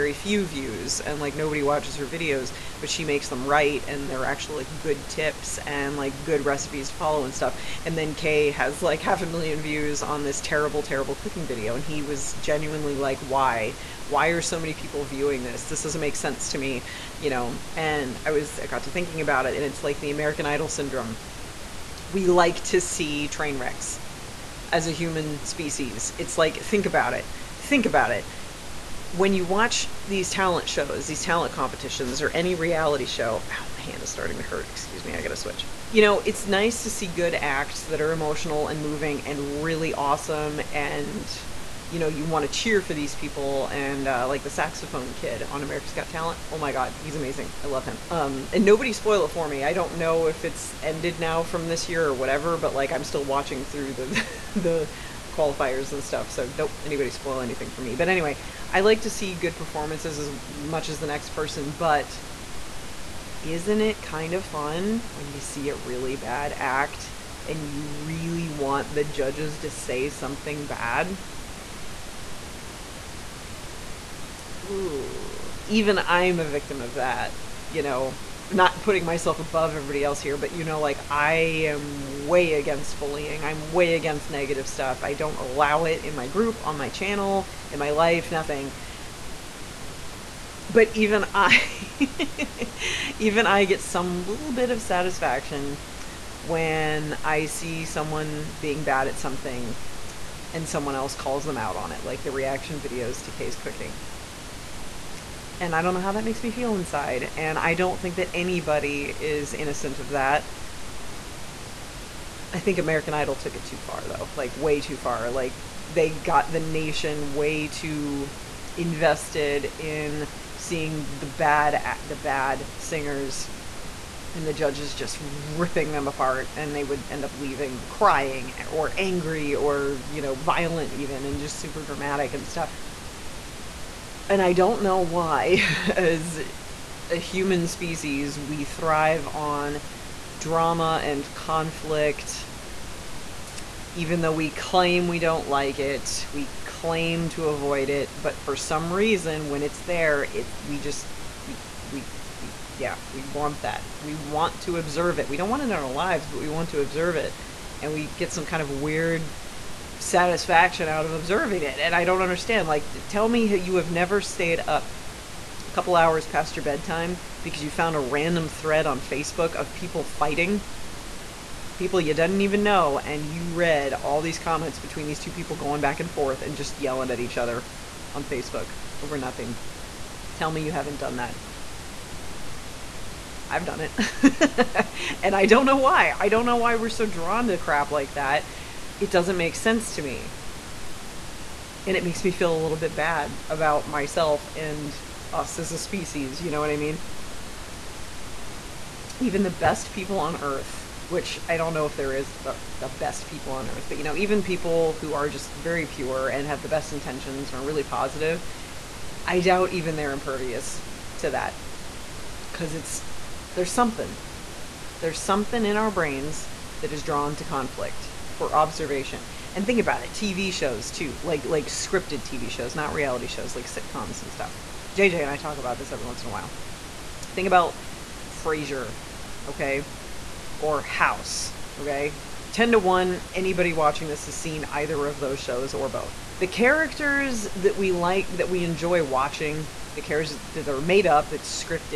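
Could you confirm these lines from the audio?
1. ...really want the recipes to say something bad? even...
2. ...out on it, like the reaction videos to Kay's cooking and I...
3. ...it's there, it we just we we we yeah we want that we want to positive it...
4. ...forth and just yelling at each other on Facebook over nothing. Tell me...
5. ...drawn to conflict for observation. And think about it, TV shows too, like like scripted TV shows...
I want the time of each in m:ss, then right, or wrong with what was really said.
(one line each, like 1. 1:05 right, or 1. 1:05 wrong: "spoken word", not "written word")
1. 1:07 wrong: "judges", not "recipes"
2. 1:41 right
3. 2:29 wrong: "observe", not "positive"
4. 2:56 right
5. 3:37 right.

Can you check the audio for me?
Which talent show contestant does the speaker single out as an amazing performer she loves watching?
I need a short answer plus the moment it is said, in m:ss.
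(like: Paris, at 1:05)
the saxophone kid, at 0:44.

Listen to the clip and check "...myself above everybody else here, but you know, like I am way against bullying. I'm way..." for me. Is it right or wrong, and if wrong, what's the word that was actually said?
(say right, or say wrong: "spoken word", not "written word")
right.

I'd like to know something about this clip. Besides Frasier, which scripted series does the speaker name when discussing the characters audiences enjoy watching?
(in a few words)
House.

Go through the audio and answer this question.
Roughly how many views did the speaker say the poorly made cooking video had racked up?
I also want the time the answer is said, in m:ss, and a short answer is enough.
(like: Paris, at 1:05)
half a million, at 0:09.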